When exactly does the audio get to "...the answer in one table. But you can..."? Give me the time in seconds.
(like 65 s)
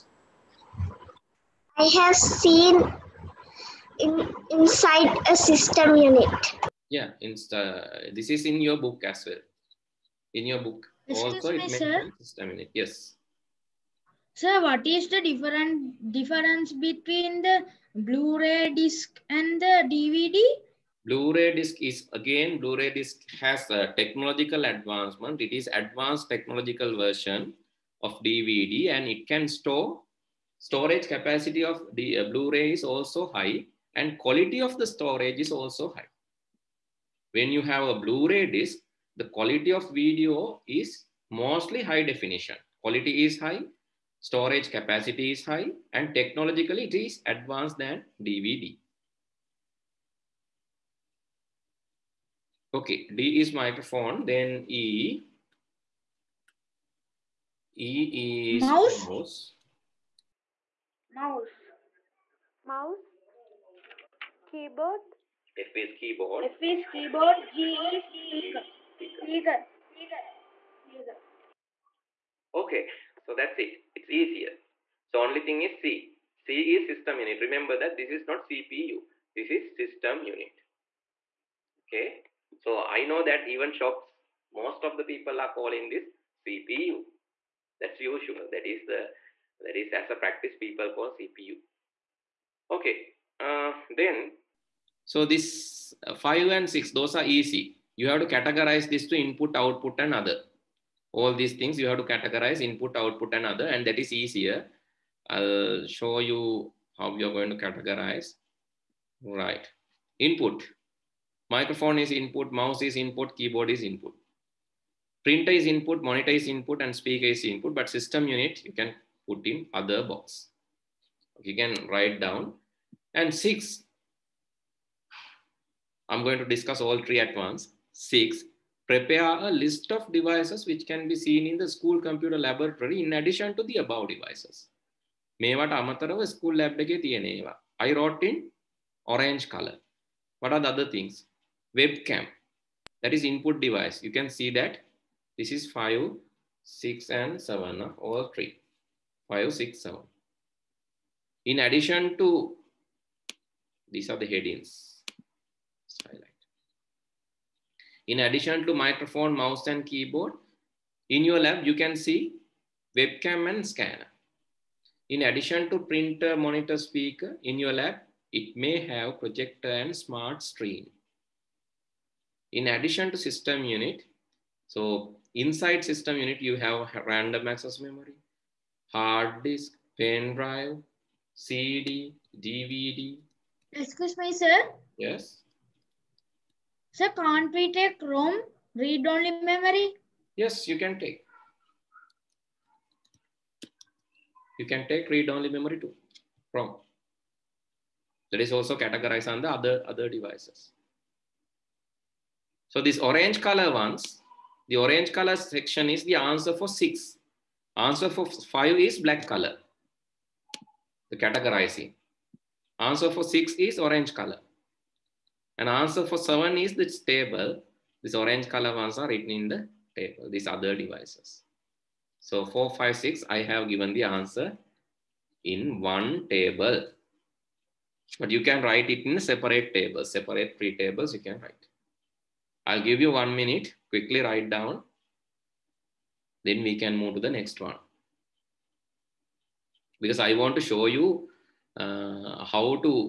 223 s.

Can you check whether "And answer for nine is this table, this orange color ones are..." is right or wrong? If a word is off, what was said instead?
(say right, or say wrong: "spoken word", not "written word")
wrong: "seven", not "nine".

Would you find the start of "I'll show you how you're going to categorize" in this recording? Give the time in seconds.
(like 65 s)
105 s.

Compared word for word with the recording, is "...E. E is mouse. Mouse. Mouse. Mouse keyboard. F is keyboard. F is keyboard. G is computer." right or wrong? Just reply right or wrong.
wrong.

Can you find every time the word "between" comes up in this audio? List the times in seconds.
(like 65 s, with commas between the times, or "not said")
16 s.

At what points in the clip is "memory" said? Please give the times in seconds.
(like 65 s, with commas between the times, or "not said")
177 s, 189 s, 195 s.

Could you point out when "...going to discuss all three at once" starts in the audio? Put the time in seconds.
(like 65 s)
126 s.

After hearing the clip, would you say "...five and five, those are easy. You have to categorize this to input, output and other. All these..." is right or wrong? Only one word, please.
wrong.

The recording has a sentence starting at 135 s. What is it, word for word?
මේවට අමතරව I wrote in orange color.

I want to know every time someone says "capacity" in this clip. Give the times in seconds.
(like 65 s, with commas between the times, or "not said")
31 s, 44 s.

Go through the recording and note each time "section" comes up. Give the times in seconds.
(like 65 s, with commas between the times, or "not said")
205 s.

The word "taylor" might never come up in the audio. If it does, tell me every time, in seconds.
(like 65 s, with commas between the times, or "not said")
not said.